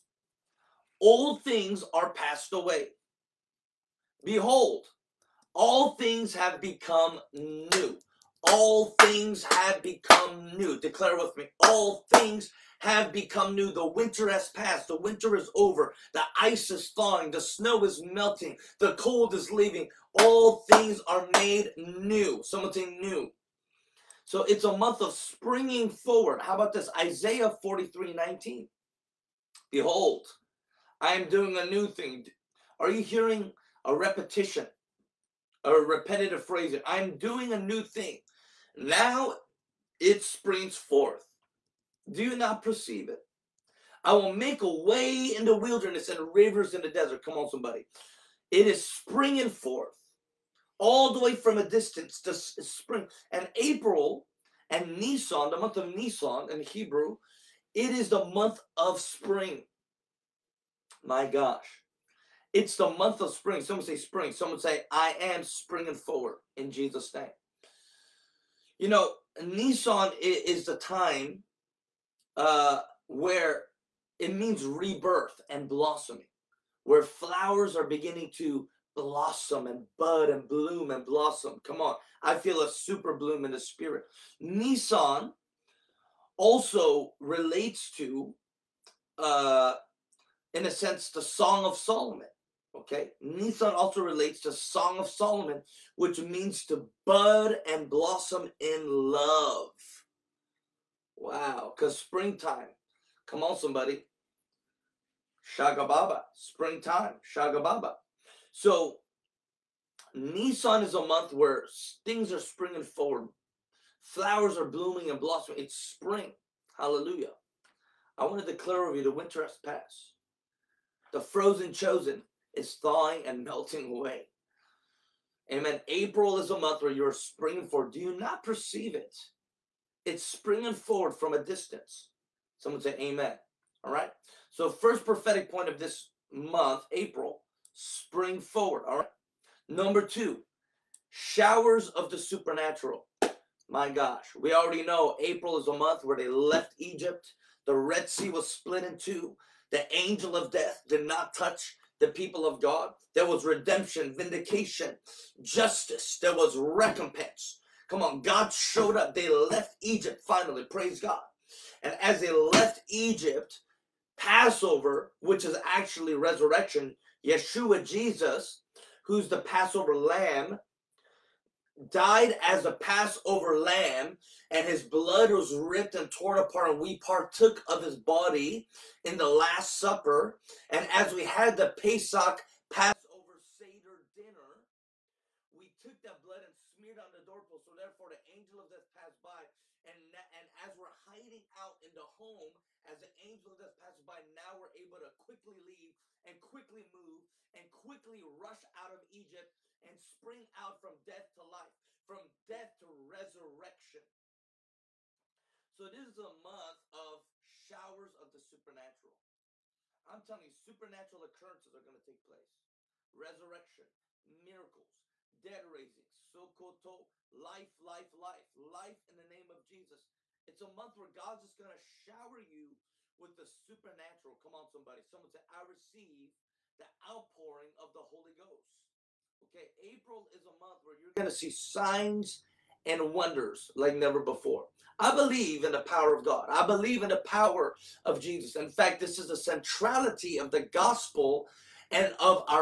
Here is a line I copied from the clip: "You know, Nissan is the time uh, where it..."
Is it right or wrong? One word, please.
right.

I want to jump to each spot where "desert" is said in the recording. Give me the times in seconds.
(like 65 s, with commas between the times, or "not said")
46 s.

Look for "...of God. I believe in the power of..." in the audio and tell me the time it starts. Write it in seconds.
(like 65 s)
236 s.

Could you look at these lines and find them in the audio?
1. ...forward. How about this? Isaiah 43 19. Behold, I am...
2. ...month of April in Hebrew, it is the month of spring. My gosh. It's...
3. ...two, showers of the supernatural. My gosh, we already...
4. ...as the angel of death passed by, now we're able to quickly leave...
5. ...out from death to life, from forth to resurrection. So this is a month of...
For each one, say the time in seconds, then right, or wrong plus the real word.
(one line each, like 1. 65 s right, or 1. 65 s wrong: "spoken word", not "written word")
1. 25 s right
2. 55 s wrong: "Nisan", not "April"
3. 140 s right
4. 192 s right
5. 200 s wrong: "death", not "forth".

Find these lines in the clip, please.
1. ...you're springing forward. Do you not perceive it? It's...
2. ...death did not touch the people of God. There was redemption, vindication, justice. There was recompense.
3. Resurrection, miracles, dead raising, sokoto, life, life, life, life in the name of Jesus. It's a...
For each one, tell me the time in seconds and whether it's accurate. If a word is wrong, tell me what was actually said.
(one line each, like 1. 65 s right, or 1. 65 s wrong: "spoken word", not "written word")
1. 126 s right
2. 150 s right
3. 213 s right.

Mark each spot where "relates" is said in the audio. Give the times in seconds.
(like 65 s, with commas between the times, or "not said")
87 s, 93 s.